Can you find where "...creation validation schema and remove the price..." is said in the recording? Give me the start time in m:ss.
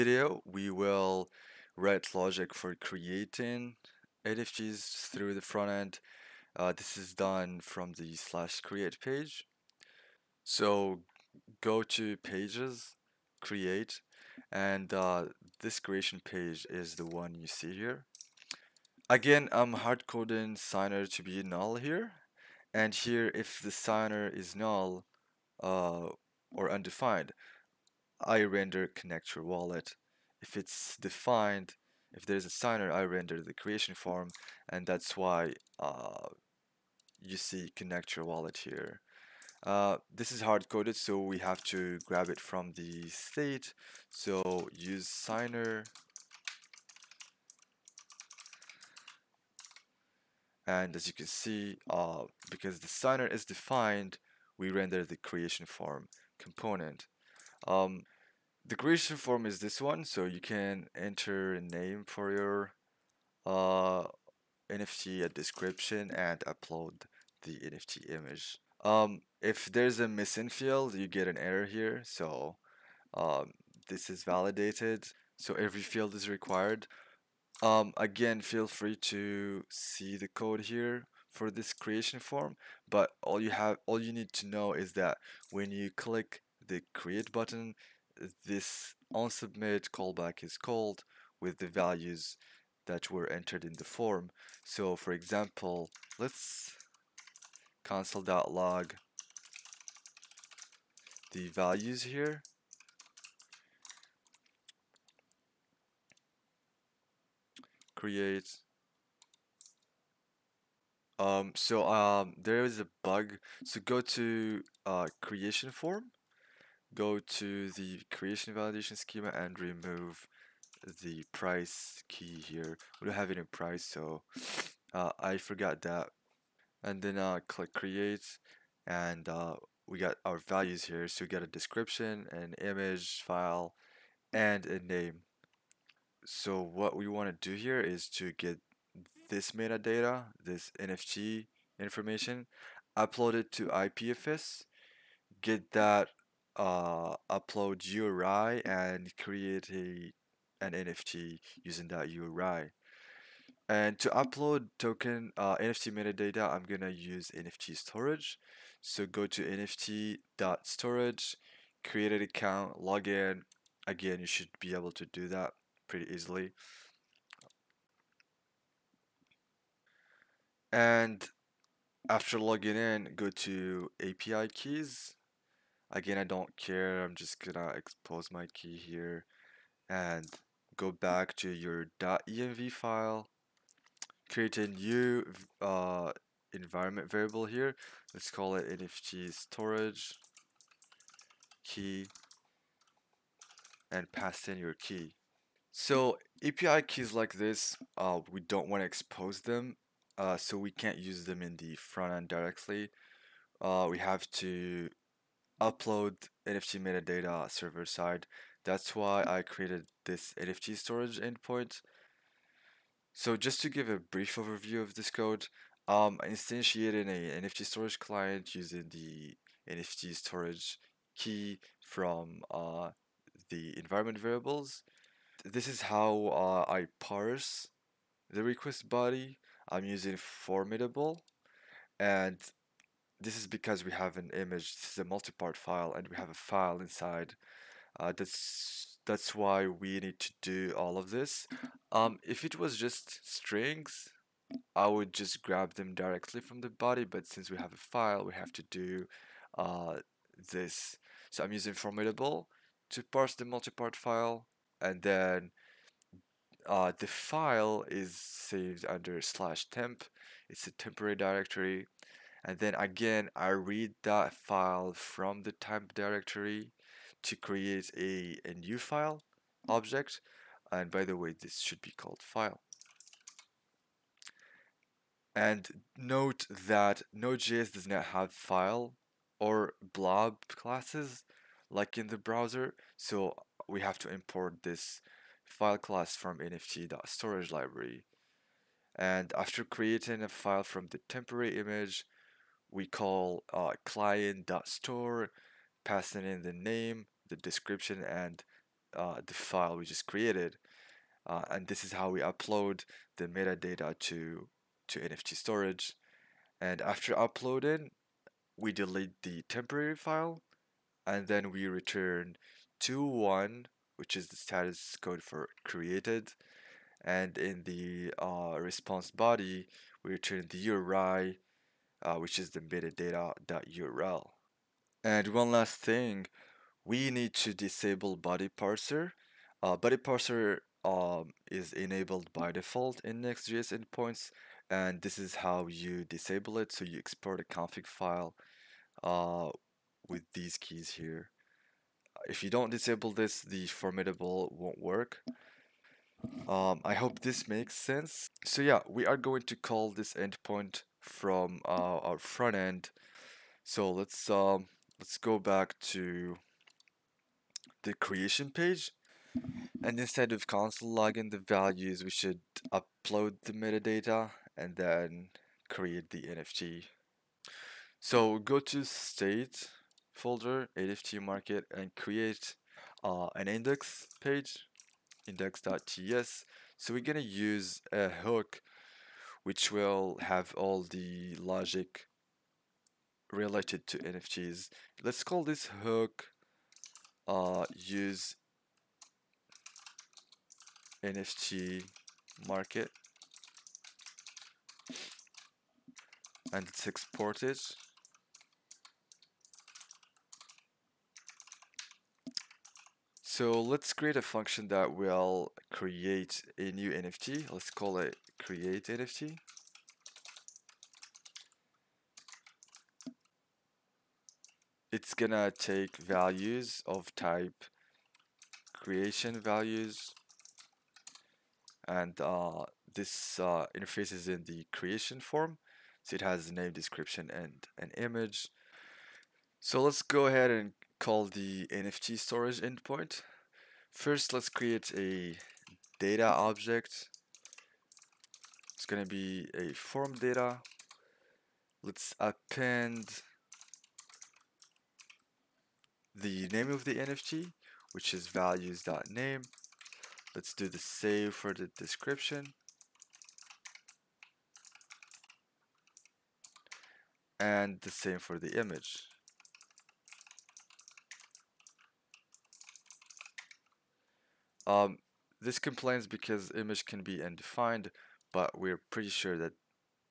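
1:58.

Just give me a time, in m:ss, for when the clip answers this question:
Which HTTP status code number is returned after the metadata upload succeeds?
5:12.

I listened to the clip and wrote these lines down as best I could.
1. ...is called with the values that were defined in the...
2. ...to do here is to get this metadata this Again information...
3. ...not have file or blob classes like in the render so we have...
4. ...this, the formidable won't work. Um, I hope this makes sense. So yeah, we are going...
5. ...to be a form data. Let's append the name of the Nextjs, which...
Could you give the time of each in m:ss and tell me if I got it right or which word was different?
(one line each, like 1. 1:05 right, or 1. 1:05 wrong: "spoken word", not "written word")
1. 1:30 wrong: "entered", not "defined"
2. 2:17 wrong: "NFT", not "Again"
3. 4:37 wrong: "browser", not "render"
4. 5:43 right
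5. 7:19 wrong: "NFT", not "Nextjs".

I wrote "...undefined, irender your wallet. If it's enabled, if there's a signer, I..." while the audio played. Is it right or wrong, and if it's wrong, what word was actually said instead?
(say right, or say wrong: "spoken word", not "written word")
wrong: "defined", not "enabled".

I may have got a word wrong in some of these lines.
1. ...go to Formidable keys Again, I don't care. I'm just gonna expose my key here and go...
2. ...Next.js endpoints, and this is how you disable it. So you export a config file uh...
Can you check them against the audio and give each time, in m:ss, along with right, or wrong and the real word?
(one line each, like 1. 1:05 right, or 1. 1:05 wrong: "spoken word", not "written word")
1. 2:53 wrong: "API", not "Formidable"
2. 5:33 right.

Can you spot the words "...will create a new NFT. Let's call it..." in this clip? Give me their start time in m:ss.
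6:44.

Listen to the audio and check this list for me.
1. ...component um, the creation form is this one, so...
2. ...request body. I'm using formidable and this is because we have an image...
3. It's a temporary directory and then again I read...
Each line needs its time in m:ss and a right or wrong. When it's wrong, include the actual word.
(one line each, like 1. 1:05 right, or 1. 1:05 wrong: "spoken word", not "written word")
1. 0:56 right
2. 3:48 right
3. 4:20 right.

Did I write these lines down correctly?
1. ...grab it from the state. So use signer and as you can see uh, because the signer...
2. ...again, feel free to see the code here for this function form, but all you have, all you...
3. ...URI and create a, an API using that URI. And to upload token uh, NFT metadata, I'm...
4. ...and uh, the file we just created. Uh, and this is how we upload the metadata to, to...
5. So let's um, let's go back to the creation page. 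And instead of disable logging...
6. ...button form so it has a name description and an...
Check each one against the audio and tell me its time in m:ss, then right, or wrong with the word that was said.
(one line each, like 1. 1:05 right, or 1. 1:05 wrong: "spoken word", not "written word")
1. 0:42 right
2. 1:17 wrong: "creation", not "function"
3. 2:27 wrong: "NFT", not "API"
4. 4:58 right
5. 5:53 wrong: "console", not "disable"
6. 7:04 wrong: "creation", not "button".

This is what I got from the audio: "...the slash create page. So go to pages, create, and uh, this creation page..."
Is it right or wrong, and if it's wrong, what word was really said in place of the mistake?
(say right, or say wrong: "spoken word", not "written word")
right.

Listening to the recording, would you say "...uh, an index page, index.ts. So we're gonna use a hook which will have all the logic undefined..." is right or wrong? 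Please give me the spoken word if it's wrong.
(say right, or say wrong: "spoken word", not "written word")
wrong: "related", not "undefined".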